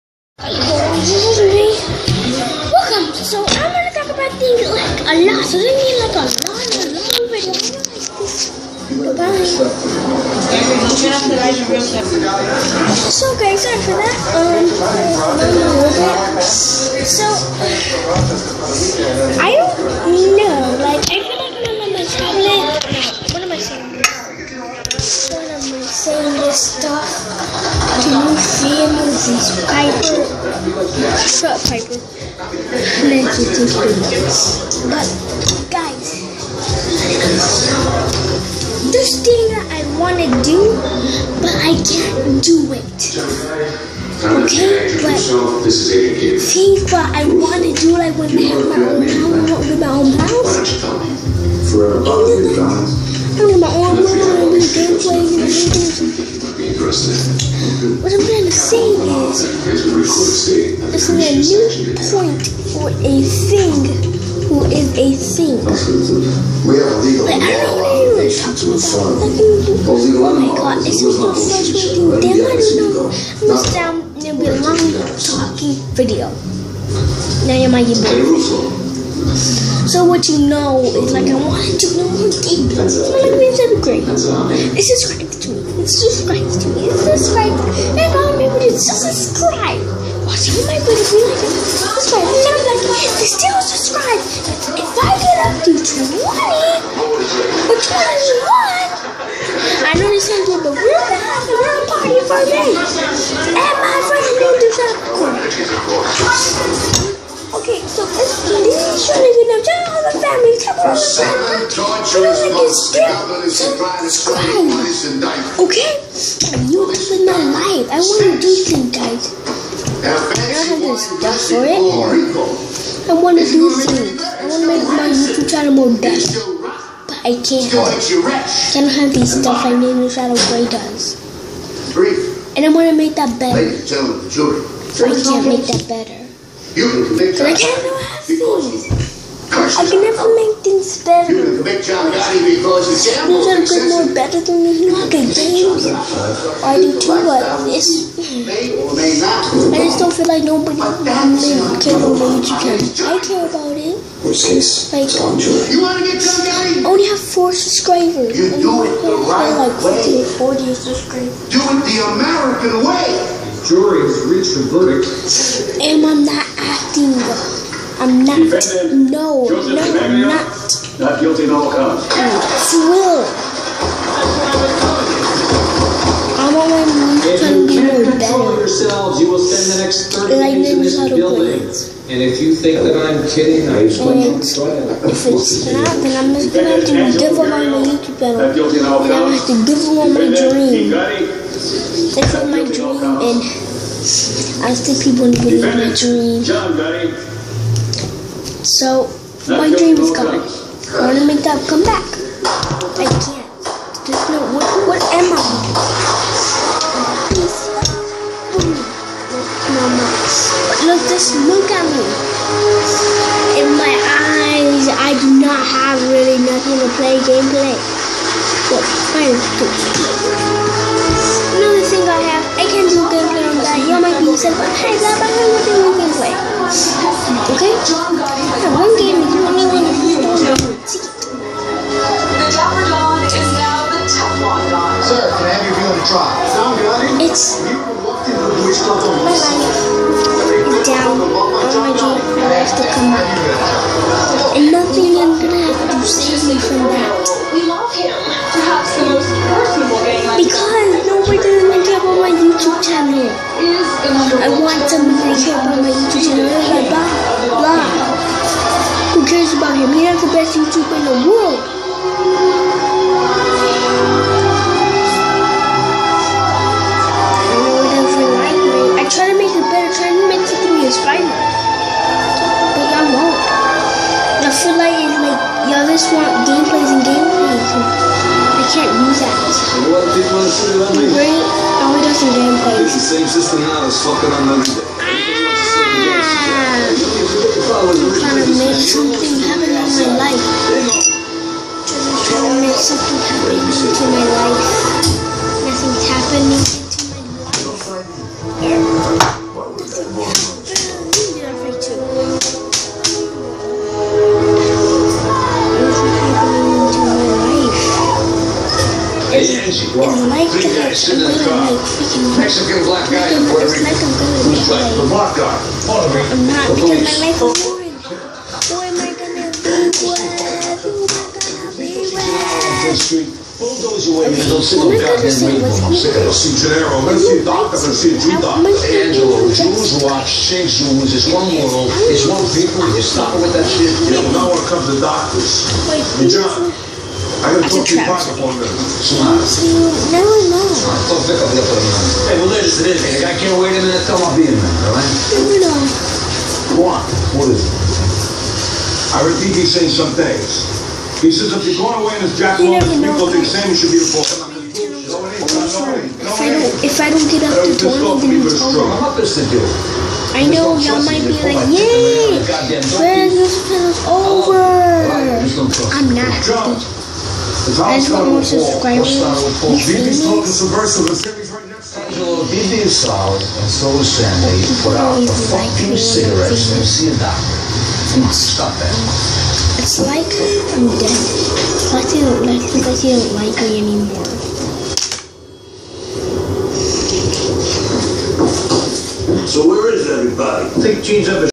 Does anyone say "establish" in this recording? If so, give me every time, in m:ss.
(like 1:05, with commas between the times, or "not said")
not said.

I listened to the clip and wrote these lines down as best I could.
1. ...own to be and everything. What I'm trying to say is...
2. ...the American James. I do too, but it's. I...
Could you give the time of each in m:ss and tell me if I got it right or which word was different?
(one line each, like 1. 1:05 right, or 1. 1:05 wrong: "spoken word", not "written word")
1. 0:53 right
2. 2:24 wrong: "Hugo", not "American".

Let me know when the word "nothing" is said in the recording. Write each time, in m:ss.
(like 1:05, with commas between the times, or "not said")
3:36, 4:04.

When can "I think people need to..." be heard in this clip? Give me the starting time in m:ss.
3:14.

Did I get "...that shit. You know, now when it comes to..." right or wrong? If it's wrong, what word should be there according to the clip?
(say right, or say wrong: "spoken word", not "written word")
right.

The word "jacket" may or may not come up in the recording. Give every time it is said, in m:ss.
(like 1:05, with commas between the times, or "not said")
5:52.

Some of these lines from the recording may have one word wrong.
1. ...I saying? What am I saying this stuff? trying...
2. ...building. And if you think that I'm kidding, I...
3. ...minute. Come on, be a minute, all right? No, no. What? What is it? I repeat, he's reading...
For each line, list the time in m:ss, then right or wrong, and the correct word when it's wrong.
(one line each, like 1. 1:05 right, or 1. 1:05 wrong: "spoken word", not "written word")
1. 0:23 wrong: "seeing", not "trying"
2. 3:01 right
3. 5:43 wrong: "saying", not "reading".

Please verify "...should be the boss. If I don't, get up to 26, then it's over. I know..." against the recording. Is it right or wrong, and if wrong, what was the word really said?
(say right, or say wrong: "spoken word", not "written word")
wrong: "20", not "26".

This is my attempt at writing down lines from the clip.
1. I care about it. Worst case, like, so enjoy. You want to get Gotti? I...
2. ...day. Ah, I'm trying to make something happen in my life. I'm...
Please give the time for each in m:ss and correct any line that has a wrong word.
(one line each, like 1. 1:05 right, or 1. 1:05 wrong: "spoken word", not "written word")
1. 2:33 right
2. 4:44 right.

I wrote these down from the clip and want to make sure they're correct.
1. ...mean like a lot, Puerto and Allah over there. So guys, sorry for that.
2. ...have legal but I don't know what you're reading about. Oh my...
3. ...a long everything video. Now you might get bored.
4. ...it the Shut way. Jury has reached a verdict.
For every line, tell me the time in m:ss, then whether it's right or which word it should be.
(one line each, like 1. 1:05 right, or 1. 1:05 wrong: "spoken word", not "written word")
1. 0:05 wrong: "Allah", not "Puerto"
2. 1:06 wrong: "talking", not "reading"
3. 1:14 wrong: "talking", not "everything"
4. 2:41 wrong: "American", not "Shut".